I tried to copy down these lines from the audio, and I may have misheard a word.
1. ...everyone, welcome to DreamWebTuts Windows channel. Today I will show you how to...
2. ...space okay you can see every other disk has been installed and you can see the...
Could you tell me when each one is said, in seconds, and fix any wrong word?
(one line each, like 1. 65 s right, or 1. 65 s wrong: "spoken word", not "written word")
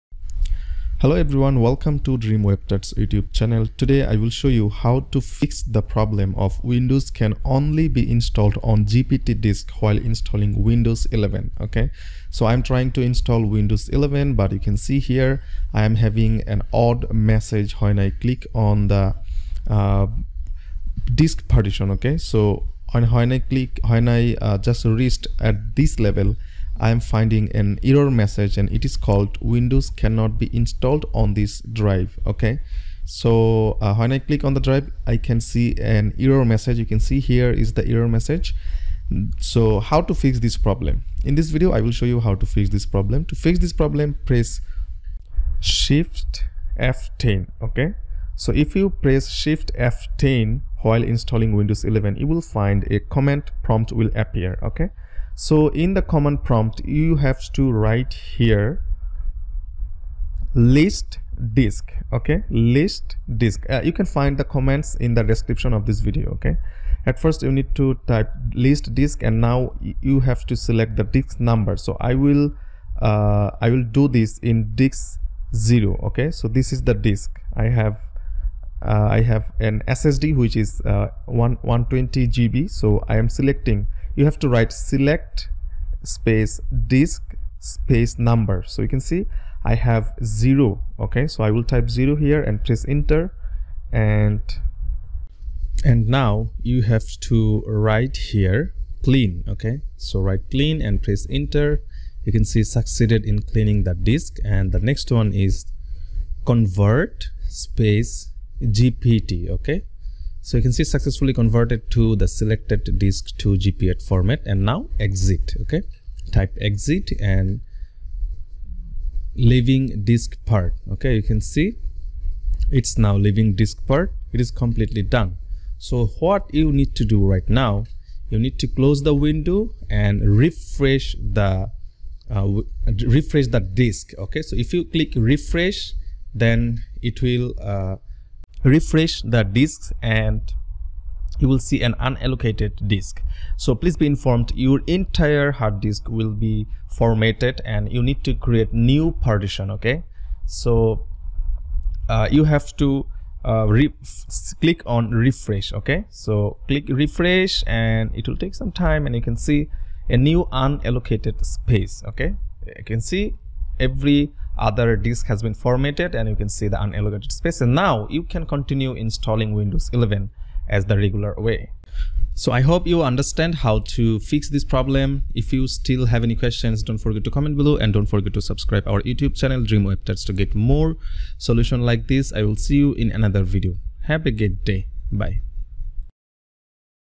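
1. 1 s wrong: "YouTube", not "Windows"
2. 161 s wrong: "formatted", not "installed".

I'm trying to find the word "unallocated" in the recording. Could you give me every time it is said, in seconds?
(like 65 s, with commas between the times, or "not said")
141 s, 160 s, 166 s.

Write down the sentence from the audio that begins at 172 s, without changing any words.
So I hope you understand how to fix this problem.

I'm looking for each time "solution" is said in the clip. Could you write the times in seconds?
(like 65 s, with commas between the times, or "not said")
181 s.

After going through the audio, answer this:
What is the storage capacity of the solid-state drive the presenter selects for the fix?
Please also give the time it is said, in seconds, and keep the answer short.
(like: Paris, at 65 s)
120 GB, at 81 s.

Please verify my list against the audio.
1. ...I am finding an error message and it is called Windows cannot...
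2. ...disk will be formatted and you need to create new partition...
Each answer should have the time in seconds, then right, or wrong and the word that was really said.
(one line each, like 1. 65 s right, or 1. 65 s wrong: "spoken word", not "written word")
1. 26 s right
2. 145 s right.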